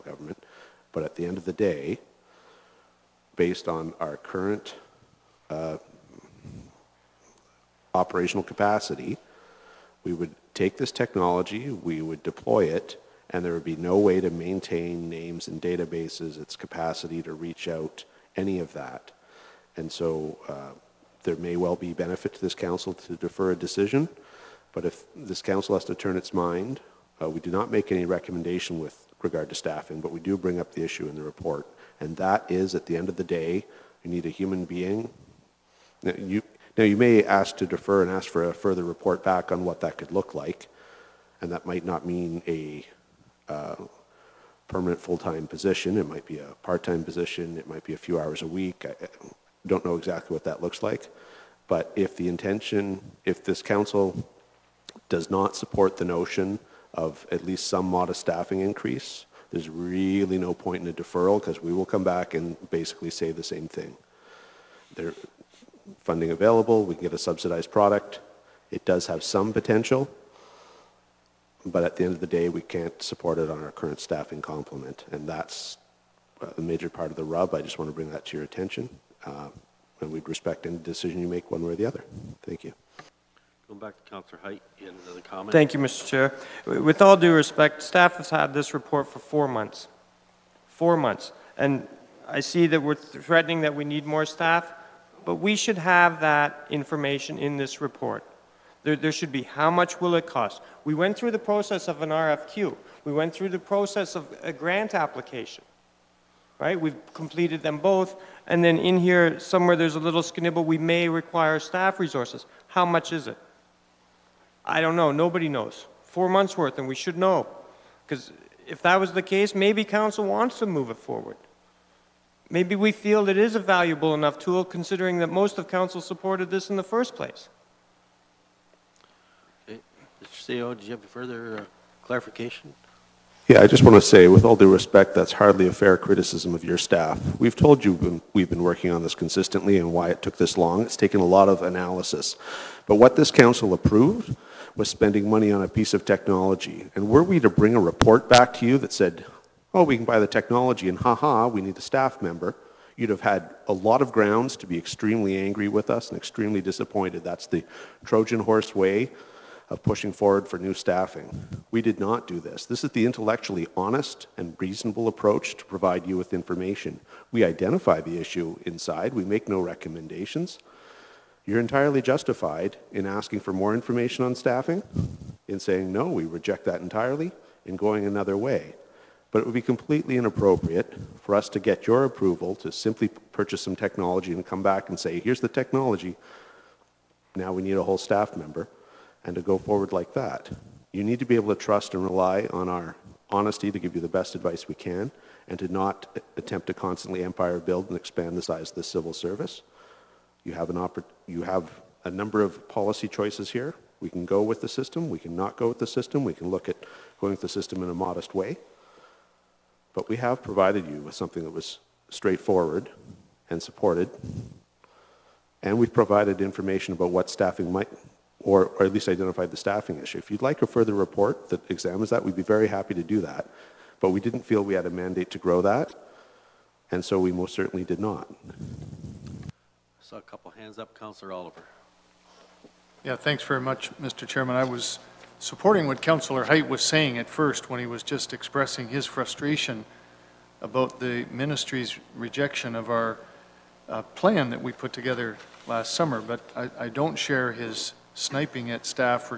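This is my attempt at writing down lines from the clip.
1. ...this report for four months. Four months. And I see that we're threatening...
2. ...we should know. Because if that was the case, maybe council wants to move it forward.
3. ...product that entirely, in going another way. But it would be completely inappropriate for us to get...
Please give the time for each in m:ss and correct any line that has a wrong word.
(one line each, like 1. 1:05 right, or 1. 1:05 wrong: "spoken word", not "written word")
1. 1:28 right
2. 1:56 right
3. 2:56 wrong: "reject", not "product".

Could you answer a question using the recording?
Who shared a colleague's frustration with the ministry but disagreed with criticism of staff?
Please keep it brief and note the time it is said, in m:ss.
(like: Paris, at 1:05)
Councillor Oliver, at 3:50.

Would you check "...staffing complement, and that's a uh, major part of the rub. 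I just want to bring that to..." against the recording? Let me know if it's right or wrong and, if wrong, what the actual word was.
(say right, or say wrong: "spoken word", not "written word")
right.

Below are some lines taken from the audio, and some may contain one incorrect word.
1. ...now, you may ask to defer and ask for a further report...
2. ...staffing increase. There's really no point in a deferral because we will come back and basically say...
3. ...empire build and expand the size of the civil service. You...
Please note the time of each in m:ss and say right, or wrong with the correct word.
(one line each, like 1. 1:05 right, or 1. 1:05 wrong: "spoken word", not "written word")
1. 0:36 right
2. 0:58 right
3. 3:17 right.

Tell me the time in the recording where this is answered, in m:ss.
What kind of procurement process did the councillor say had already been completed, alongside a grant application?
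1:42.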